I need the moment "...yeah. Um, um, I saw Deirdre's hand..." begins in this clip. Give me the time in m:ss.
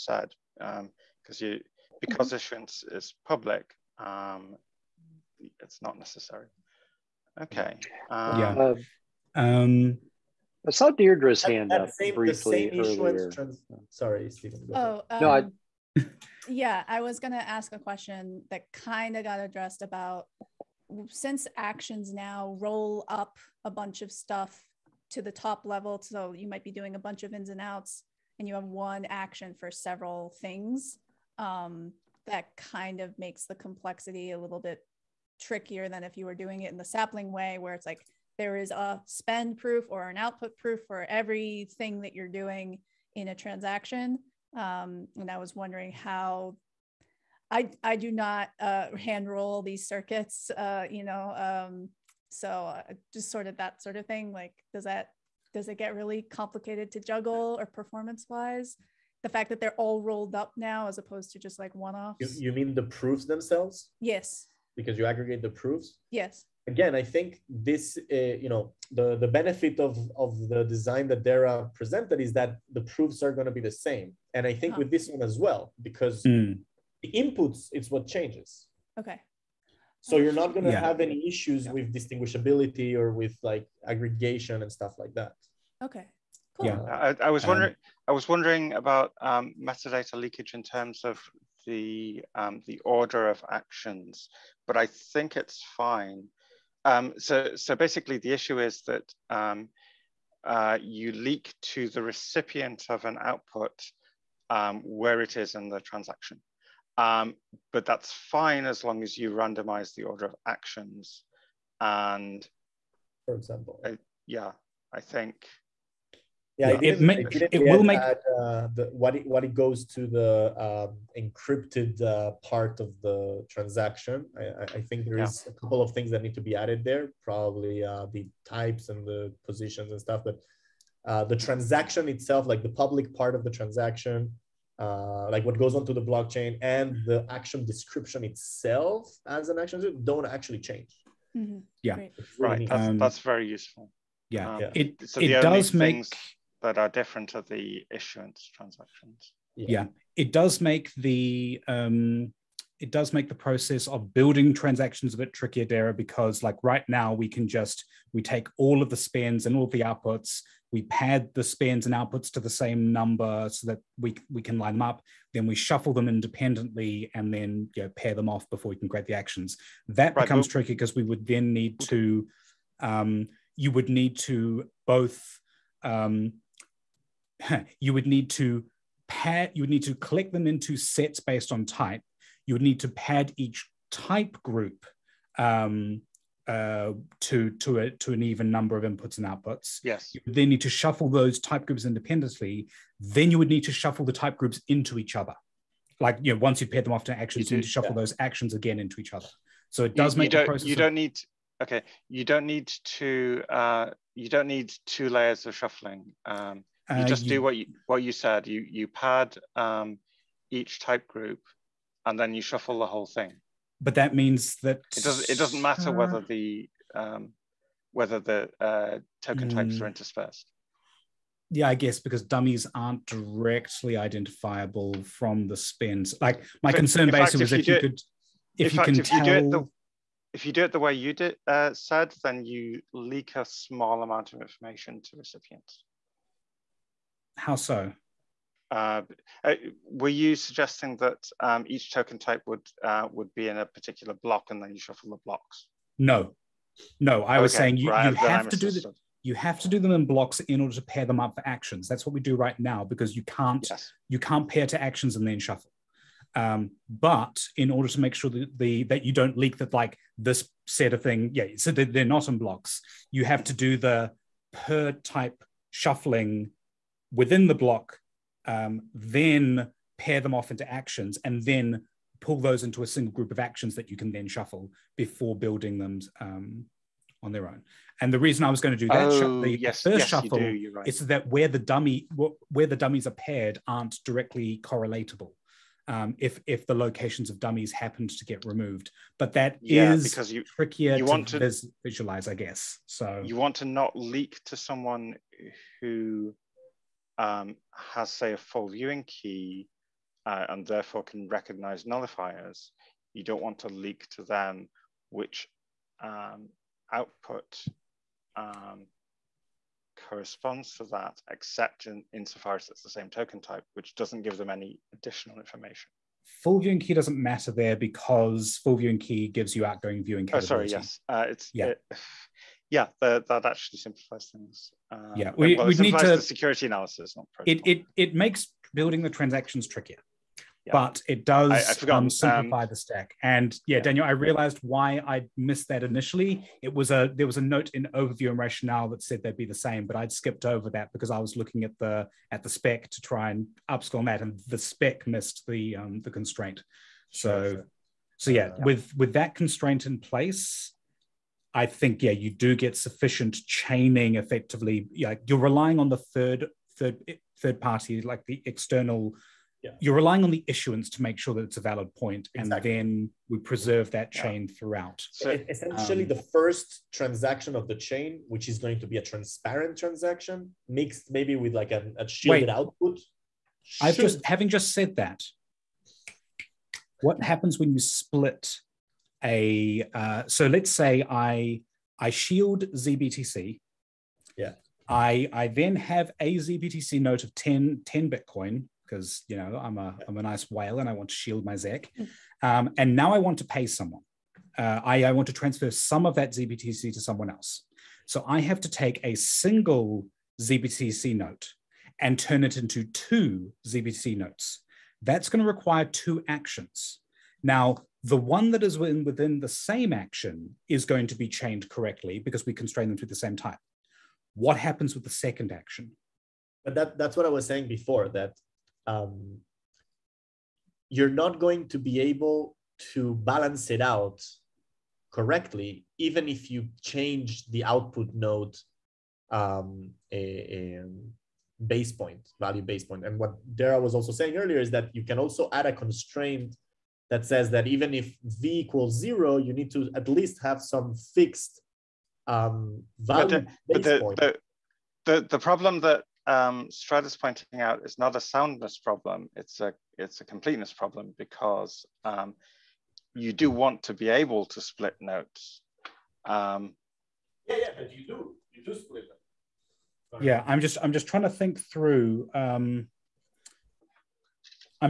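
0:08.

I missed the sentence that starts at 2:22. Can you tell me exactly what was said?
Um, that's, um, that's very useful.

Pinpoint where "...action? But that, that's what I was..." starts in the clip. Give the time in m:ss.
6:55.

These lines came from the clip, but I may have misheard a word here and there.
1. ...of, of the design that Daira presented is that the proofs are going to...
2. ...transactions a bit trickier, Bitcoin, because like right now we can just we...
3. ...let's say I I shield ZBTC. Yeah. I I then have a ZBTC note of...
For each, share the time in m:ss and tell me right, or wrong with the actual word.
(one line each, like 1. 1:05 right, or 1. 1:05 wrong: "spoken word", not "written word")
1. 1:09 right
2. 2:34 wrong: "Daira", not "Bitcoin"
3. 6:20 right.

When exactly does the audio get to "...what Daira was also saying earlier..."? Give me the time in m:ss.
7:13.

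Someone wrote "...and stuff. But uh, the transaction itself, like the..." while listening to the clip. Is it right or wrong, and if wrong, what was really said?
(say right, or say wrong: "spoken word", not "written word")
right.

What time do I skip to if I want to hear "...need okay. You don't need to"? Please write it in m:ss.
3:20.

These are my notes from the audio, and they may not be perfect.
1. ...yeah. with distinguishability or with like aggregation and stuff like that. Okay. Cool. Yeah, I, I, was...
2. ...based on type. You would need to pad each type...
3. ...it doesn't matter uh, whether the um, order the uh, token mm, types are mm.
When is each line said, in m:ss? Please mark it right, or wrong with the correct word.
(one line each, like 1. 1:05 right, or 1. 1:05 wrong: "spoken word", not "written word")
1. 1:21 right
2. 3:01 right
3. 3:35 wrong: "whether", not "order".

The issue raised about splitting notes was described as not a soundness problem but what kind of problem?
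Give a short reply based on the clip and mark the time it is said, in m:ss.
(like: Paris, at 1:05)
Completeness problem, at 7:30.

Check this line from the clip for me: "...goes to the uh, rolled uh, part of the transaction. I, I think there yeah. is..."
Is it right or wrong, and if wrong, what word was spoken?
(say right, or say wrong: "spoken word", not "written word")
wrong: "encrypted", not "rolled".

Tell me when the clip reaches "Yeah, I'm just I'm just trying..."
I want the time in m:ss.
7:40.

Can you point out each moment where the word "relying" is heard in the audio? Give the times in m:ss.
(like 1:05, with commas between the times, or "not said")
5:55, 5:59.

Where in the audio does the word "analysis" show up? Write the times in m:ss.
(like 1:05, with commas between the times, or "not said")
5:26.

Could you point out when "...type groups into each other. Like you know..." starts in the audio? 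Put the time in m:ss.
3:14.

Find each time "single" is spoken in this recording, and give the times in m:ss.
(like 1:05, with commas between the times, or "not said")
4:32, 6:39.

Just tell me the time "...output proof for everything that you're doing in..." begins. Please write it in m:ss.
0:40.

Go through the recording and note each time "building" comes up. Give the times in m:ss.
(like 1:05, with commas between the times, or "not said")
2:34, 4:35, 5:28.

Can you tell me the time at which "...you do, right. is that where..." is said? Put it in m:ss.
4:40.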